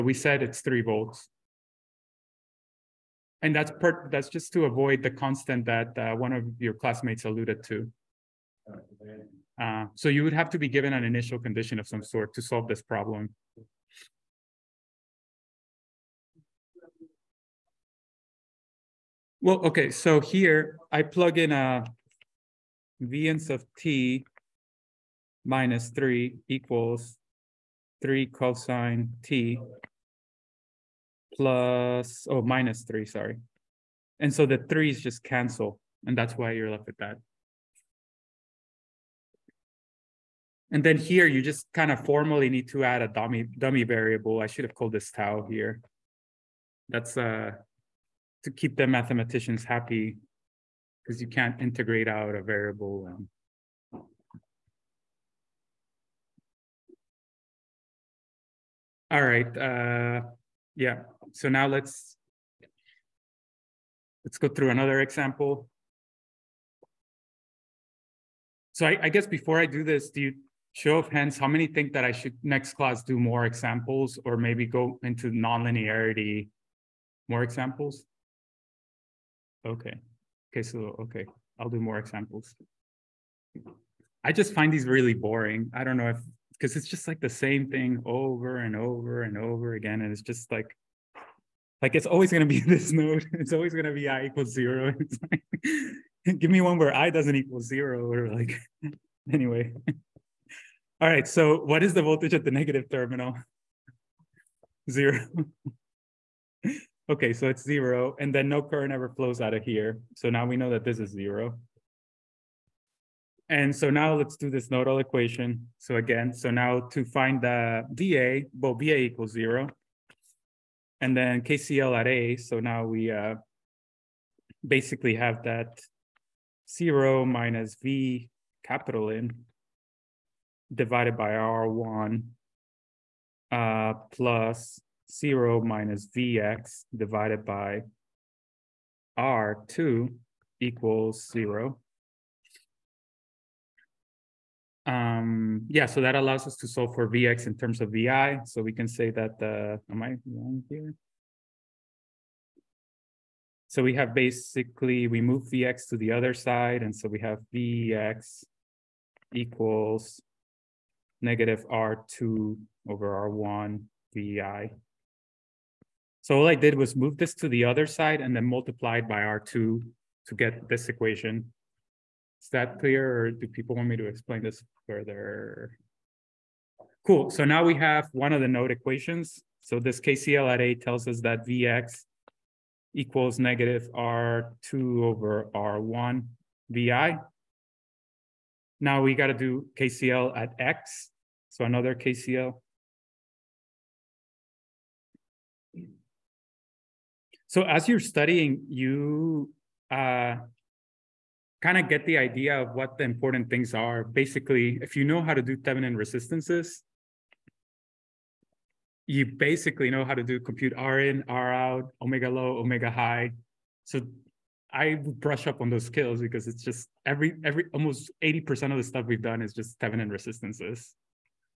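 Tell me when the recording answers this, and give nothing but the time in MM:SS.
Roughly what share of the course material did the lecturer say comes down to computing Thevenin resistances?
03:38.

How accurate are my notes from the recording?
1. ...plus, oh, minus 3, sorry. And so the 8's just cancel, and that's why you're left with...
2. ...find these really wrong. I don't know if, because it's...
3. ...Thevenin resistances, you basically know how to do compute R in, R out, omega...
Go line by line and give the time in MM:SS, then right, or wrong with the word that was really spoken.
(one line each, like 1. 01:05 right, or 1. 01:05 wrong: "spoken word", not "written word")
1. 00:31 wrong: "3", not "8"
2. 01:24 wrong: "boring", not "wrong"
3. 03:25 right.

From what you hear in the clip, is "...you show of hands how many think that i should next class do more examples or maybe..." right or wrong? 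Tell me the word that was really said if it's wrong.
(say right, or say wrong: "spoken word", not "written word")
right.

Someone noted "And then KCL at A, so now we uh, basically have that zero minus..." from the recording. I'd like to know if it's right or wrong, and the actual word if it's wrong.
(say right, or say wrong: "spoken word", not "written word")
right.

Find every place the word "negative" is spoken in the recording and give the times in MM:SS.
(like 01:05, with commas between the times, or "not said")
01:42, 02:41, 03:03.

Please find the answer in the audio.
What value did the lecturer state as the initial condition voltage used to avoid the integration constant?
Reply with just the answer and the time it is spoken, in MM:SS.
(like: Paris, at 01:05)
3 volts, at 00:00.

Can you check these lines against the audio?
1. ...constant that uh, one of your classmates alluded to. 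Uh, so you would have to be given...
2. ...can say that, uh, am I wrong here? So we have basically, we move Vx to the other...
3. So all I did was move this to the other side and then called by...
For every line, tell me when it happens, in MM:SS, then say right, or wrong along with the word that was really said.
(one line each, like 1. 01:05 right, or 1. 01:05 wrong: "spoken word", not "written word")
1. 00:05 right
2. 02:28 right
3. 02:46 wrong: "multiplied", not "called".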